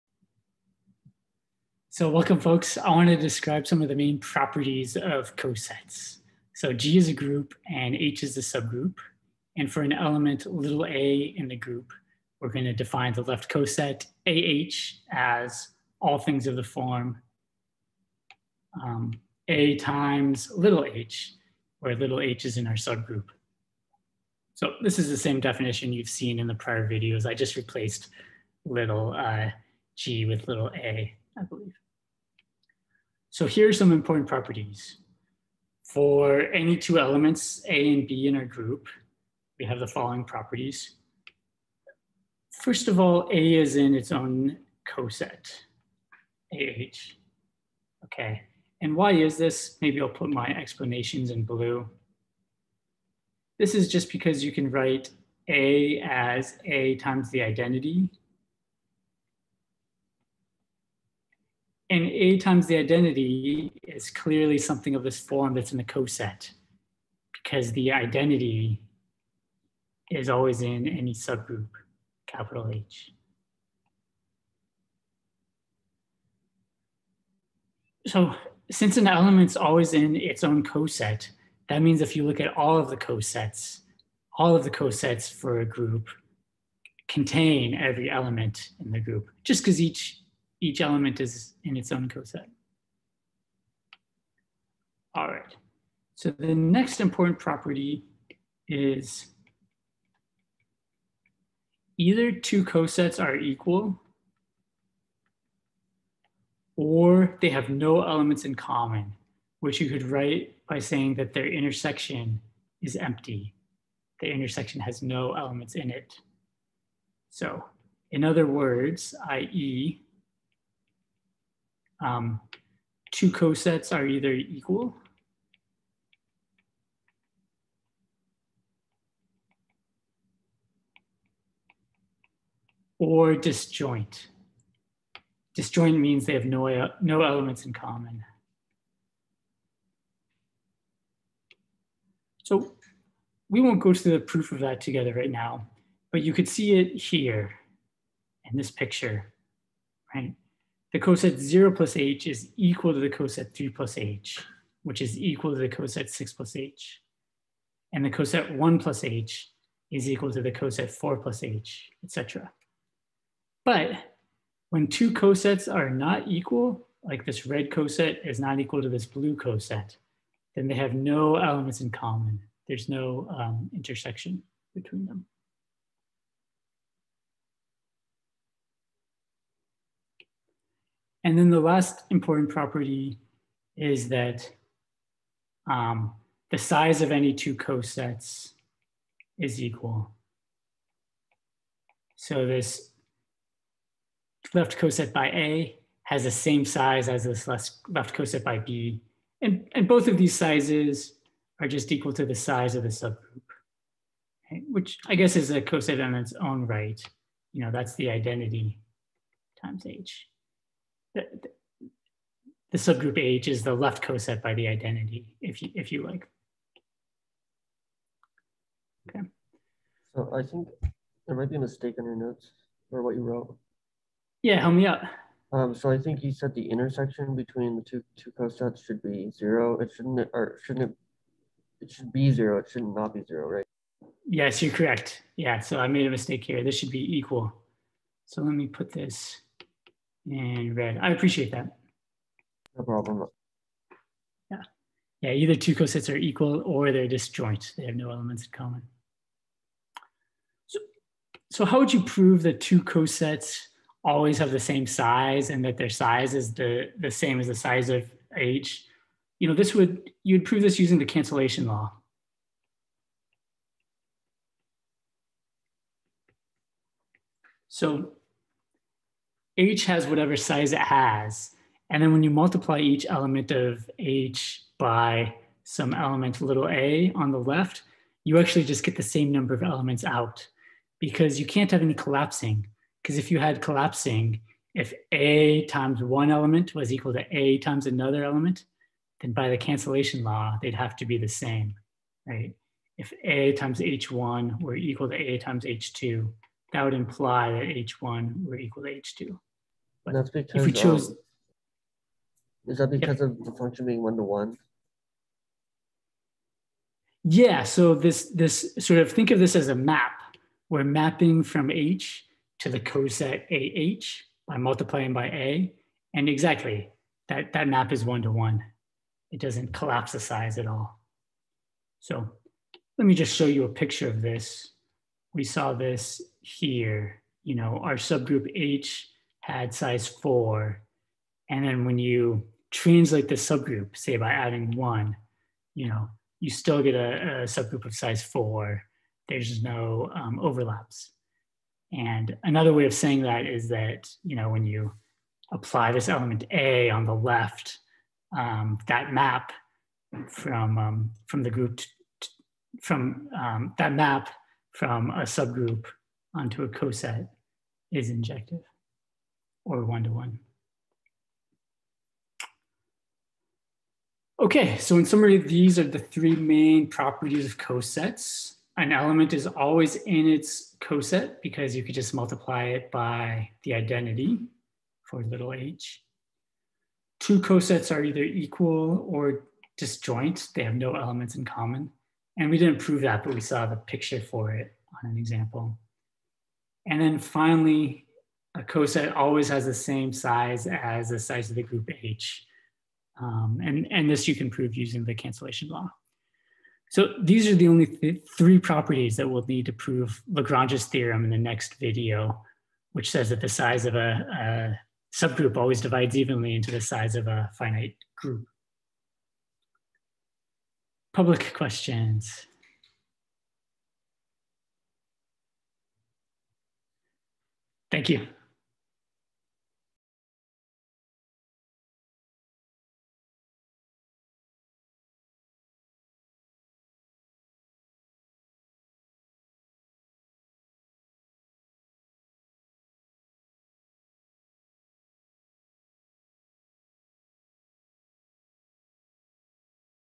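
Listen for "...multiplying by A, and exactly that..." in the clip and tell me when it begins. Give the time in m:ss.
5:14.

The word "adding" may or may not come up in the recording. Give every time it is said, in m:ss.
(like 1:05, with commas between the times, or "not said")
5:34.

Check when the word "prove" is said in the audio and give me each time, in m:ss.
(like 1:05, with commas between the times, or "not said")
4:12, 4:20, 6:22, 6:34, 6:39.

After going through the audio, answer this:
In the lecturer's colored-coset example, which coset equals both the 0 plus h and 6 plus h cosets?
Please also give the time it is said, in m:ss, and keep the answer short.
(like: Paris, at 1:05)
3 plus h, at 2:33.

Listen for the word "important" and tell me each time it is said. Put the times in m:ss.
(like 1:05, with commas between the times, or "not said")
0:33, 1:37, 3:02.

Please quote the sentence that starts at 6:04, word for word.
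Okay, so in summary, these are the three main properties of cosets.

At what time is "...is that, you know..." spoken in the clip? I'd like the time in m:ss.
5:43.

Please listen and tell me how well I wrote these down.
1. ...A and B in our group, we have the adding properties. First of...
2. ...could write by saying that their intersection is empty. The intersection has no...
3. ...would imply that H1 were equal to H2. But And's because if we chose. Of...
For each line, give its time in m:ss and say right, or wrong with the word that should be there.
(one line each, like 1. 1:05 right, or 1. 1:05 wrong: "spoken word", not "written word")
1. 0:37 wrong: "following", not "adding"
2. 1:49 right
3. 4:56 wrong: "That", not "And".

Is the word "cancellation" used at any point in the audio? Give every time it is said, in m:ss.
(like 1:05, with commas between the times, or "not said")
4:21, 4:49, 6:35.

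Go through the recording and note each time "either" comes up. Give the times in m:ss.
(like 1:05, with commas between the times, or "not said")
1:41, 2:04, 4:05, 6:18.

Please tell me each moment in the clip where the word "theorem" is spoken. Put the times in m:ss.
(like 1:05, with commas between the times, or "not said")
6:40.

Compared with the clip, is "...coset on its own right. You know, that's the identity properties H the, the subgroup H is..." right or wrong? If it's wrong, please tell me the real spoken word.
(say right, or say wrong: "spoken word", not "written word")
wrong: "times", not "properties".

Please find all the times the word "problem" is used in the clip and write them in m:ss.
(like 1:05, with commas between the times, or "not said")
4:02.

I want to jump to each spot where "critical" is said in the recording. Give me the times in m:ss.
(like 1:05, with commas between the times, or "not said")
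not said.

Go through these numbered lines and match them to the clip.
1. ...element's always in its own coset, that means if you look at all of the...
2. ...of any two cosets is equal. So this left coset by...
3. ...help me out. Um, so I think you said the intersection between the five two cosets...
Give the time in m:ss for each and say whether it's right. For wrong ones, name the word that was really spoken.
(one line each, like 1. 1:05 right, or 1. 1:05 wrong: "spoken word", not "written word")
1. 1:19 right
2. 3:07 right
3. 3:44 wrong: "two", not "five".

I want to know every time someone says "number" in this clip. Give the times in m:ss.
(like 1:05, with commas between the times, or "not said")
4:39.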